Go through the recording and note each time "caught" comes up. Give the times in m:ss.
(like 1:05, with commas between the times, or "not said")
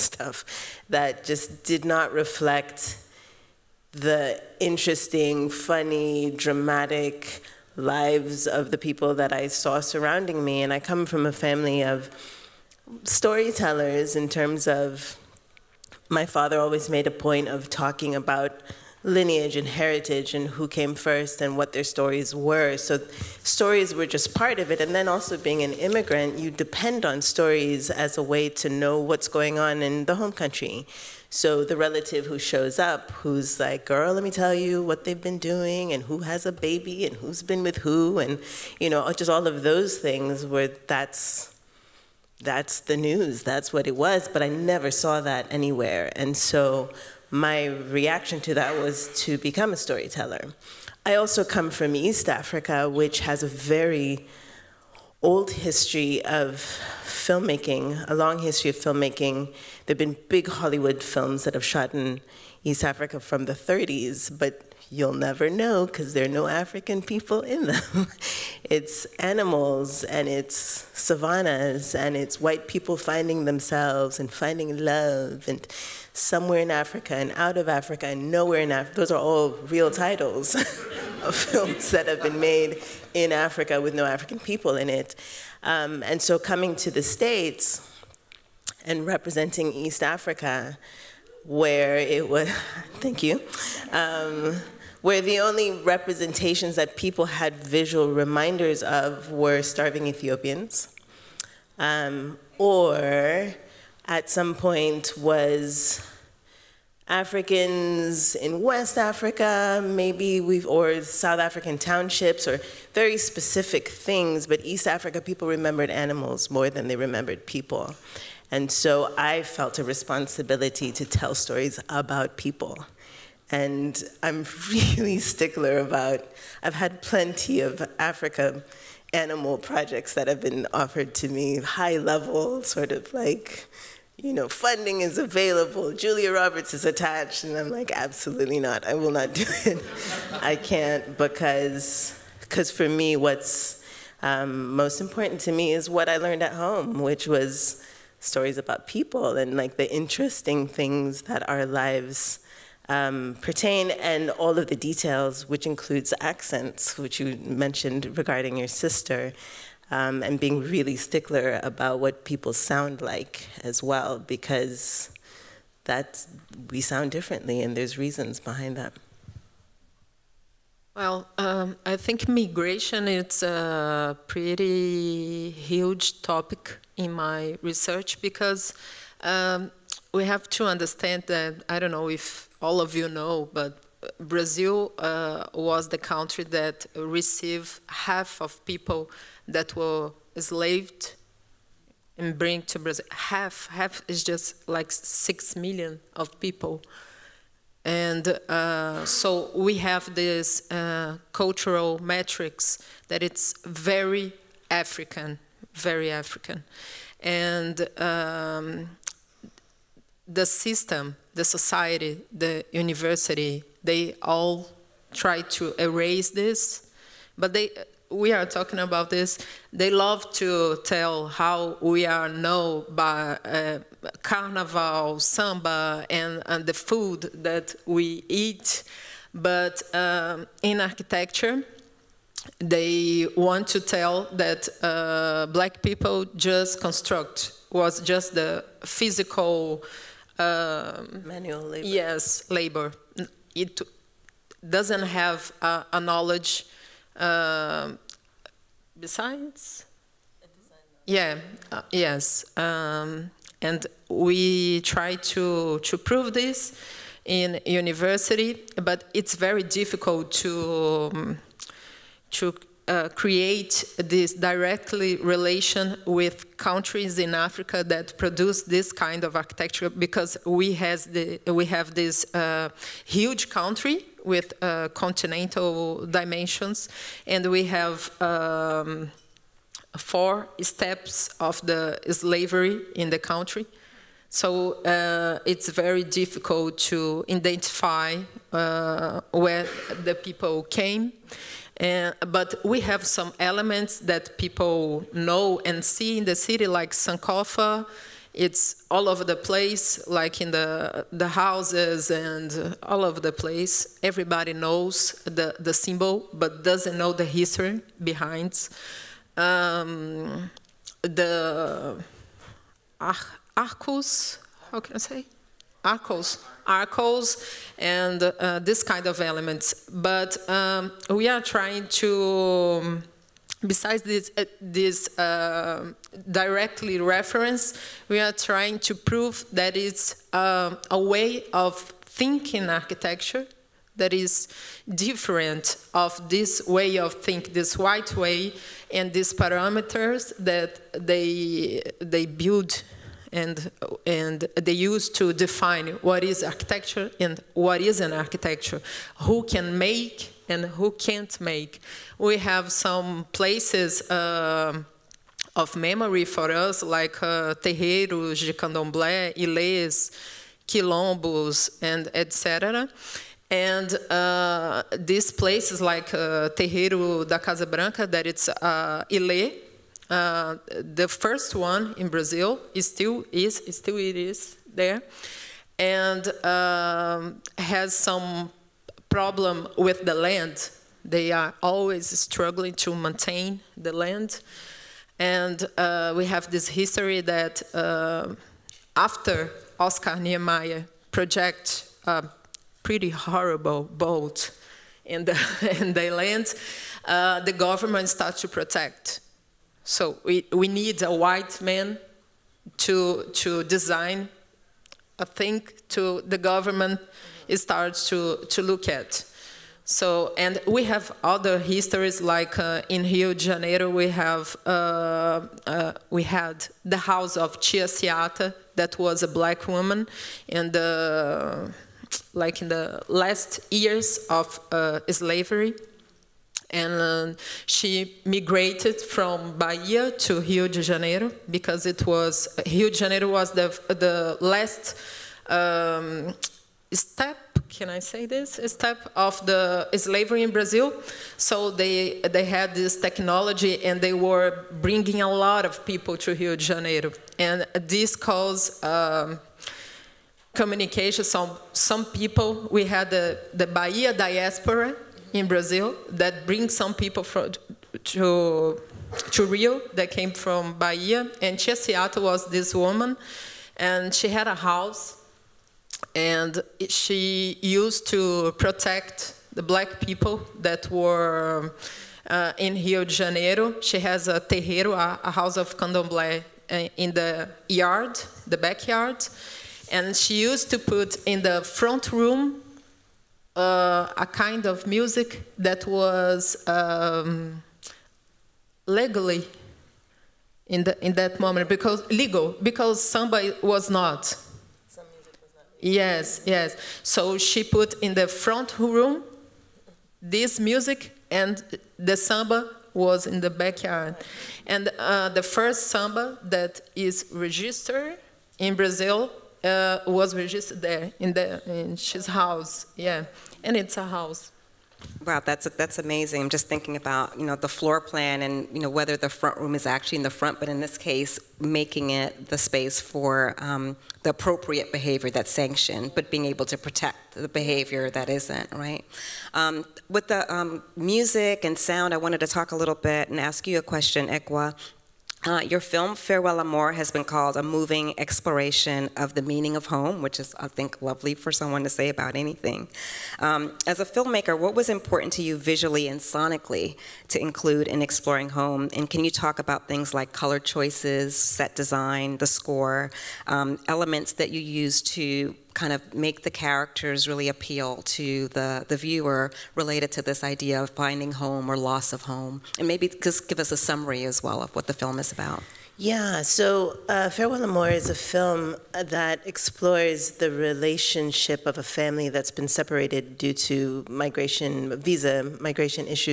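not said.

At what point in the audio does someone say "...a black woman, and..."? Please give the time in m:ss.
6:59.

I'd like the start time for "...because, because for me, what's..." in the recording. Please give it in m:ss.
2:21.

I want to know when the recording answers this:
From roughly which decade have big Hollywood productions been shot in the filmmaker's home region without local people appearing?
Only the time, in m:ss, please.
1:03.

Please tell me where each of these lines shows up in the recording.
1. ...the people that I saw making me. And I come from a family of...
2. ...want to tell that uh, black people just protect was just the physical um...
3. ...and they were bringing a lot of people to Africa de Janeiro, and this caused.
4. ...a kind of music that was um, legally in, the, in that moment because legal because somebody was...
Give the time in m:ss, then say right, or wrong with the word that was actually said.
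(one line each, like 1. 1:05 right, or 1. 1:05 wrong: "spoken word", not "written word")
1. 0:08 wrong: "surrounding", not "making"
2. 3:53 wrong: "construct", not "protect"
3. 7:23 wrong: "Rio", not "Africa"
4. 8:04 right.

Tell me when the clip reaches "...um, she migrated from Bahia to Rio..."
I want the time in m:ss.
7:07.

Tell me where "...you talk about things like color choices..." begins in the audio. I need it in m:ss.
9:09.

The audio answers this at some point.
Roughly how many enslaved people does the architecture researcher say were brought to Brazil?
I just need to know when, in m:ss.
3:14.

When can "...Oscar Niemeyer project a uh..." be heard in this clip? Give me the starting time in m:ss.
6:29.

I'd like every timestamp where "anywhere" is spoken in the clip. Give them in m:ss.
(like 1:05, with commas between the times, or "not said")
0:45.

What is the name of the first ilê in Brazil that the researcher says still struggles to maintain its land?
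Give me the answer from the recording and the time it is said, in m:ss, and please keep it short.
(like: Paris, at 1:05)
Terreiro da Casa Branca, at 6:06.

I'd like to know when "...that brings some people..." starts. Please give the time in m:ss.
7:36.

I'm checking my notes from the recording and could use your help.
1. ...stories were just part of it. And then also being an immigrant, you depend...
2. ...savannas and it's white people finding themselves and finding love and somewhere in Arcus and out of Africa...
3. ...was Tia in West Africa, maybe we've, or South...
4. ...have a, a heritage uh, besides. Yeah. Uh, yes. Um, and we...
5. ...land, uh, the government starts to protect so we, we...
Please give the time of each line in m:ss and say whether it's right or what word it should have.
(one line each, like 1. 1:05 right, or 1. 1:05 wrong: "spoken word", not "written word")
1. 0:23 right
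2. 1:10 wrong: "Africa", not "Arcus"
3. 1:45 wrong: "Africans", not "Tia"
4. 4:05 wrong: "knowledge", not "heritage"
5. 6:36 right.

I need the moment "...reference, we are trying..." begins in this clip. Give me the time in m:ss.
5:26.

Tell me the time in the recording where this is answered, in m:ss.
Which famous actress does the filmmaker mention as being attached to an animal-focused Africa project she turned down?
2:15.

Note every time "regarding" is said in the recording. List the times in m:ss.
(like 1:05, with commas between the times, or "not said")
2:38.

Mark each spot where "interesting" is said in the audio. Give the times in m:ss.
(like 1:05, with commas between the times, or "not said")
0:04, 2:29.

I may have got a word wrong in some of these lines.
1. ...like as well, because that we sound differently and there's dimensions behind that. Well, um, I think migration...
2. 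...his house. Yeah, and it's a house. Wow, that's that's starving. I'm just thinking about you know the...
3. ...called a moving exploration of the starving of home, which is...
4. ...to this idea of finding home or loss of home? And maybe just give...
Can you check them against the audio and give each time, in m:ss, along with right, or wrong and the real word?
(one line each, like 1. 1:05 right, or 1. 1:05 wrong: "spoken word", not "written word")
1. 2:43 wrong: "reasons", not "dimensions"
2. 8:31 wrong: "amazing", not "starving"
3. 8:57 wrong: "meaning", not "starving"
4. 9:20 right.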